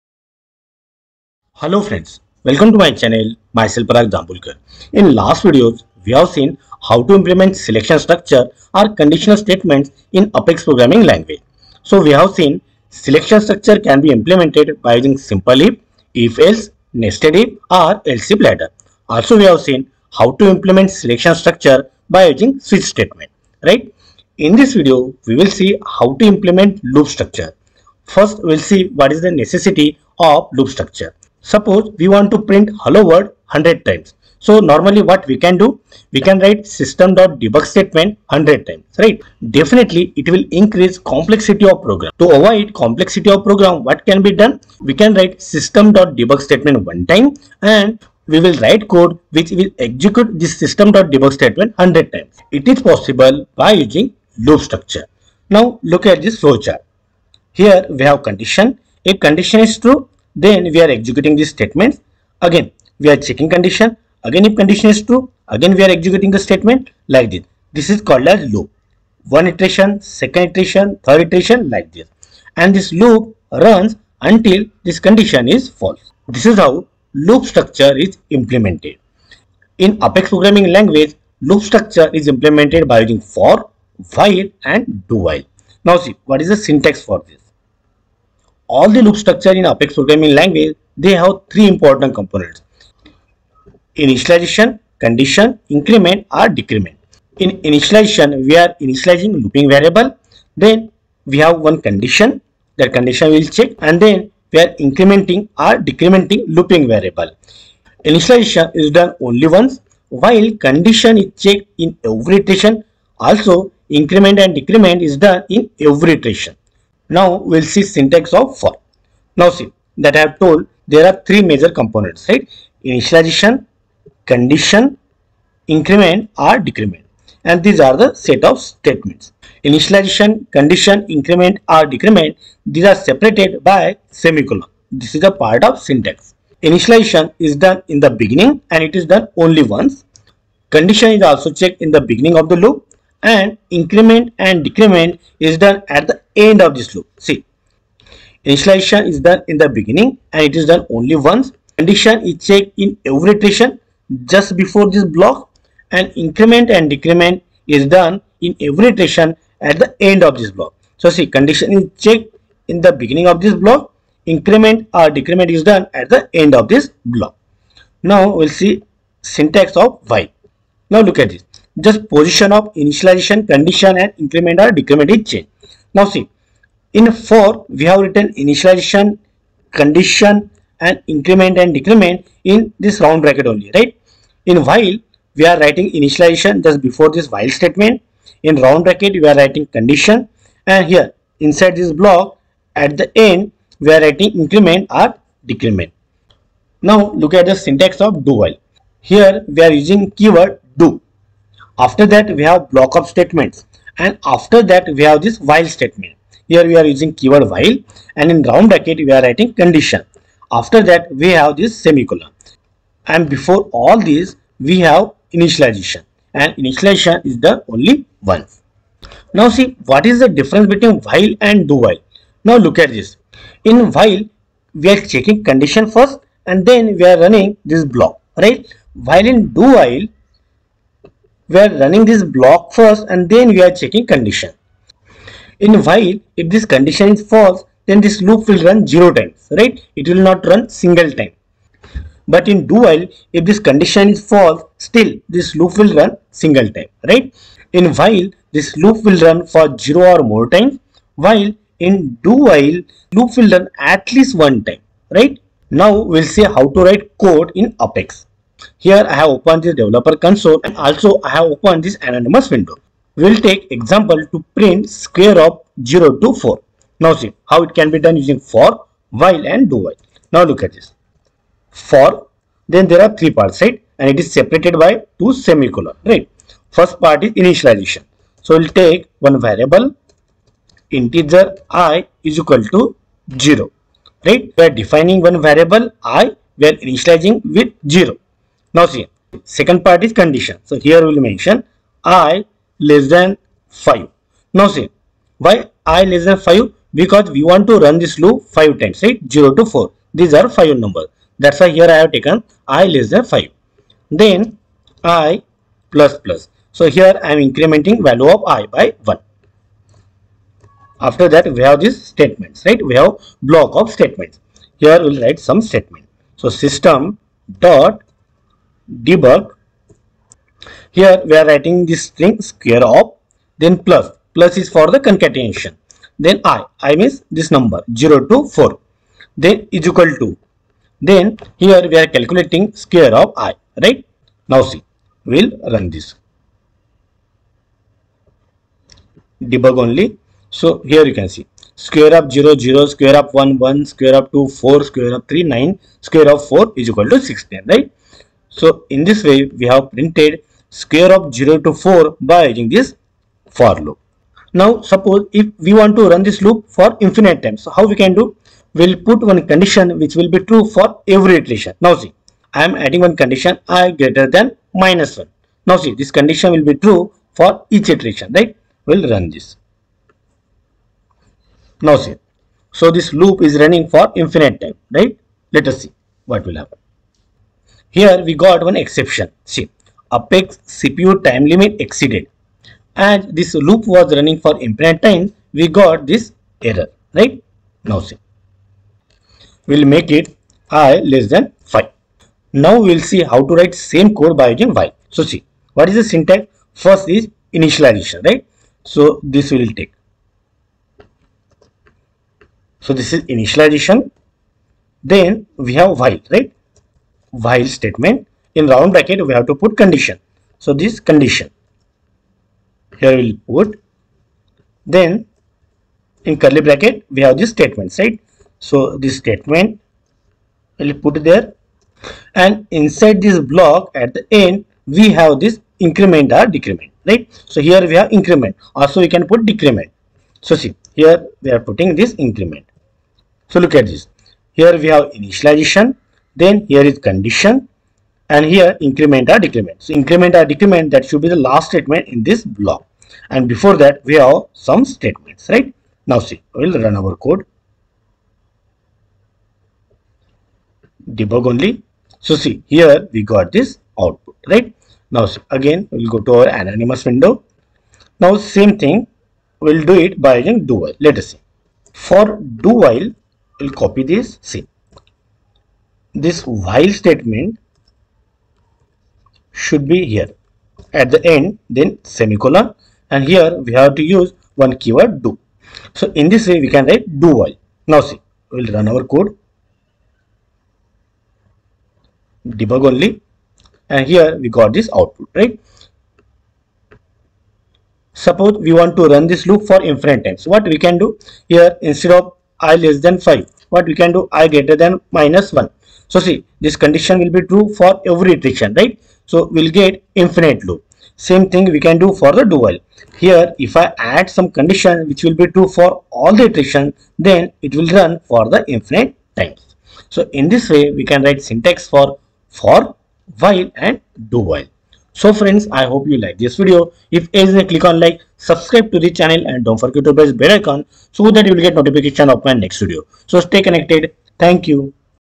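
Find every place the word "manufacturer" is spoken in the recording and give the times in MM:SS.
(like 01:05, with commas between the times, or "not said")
not said.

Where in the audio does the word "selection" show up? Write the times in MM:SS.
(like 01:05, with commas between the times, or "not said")
00:07, 00:12, 00:20.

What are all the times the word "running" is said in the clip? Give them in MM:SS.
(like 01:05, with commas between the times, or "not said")
03:47, 03:51, 06:13, 06:24.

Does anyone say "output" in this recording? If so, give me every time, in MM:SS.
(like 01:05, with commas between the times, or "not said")
07:33, 08:04.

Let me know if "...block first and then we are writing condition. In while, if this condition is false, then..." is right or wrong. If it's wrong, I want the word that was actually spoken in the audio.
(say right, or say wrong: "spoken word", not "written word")
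wrong: "checking", not "writing".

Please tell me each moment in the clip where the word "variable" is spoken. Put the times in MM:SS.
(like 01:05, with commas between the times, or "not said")
01:39, 01:46, 04:39, 04:45.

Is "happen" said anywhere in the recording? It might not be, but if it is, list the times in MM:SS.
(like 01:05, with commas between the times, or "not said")
06:16.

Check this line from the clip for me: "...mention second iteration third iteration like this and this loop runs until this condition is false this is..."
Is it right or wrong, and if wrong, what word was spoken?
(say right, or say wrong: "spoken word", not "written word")
wrong: "iteration", not "mention".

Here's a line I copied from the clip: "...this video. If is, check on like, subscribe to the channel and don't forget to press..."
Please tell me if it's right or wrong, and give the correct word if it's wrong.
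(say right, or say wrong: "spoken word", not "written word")
wrong: "click", not "check".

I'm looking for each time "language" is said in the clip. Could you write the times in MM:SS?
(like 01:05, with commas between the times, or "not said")
00:11, 01:20, 01:30.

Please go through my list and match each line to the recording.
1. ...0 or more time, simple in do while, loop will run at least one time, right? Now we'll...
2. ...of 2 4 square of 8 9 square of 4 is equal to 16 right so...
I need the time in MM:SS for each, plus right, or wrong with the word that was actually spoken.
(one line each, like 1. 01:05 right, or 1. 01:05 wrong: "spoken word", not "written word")
1. 04:09 wrong: "while", not "simple"
2. 05:44 wrong: "3", not "8".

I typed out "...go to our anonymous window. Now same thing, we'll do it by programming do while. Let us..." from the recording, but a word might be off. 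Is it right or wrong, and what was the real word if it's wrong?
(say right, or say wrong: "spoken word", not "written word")
wrong: "using", not "programming".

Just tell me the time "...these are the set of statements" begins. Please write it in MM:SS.
02:07.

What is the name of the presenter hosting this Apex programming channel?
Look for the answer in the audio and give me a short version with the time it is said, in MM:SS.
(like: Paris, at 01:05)
Parag Dambulkar, at 00:03.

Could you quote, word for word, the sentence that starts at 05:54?
Now suppose if we want to run this loop for infinite times, so how we can do?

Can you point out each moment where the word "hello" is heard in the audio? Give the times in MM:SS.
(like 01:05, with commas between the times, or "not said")
00:01, 00:32.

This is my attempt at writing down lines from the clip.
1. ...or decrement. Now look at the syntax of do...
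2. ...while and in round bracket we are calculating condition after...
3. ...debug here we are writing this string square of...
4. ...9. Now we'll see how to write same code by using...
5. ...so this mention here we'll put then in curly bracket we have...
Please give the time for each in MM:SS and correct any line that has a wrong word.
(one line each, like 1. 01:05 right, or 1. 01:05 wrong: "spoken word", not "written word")
1. 03:14 right
2. 03:27 wrong: "writing", not "calculating"
3. 05:19 right
4. 06:31 wrong: "5", not "9"
5. 06:50 wrong: "condition", not "mention".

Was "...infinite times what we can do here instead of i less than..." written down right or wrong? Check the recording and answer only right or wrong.
right.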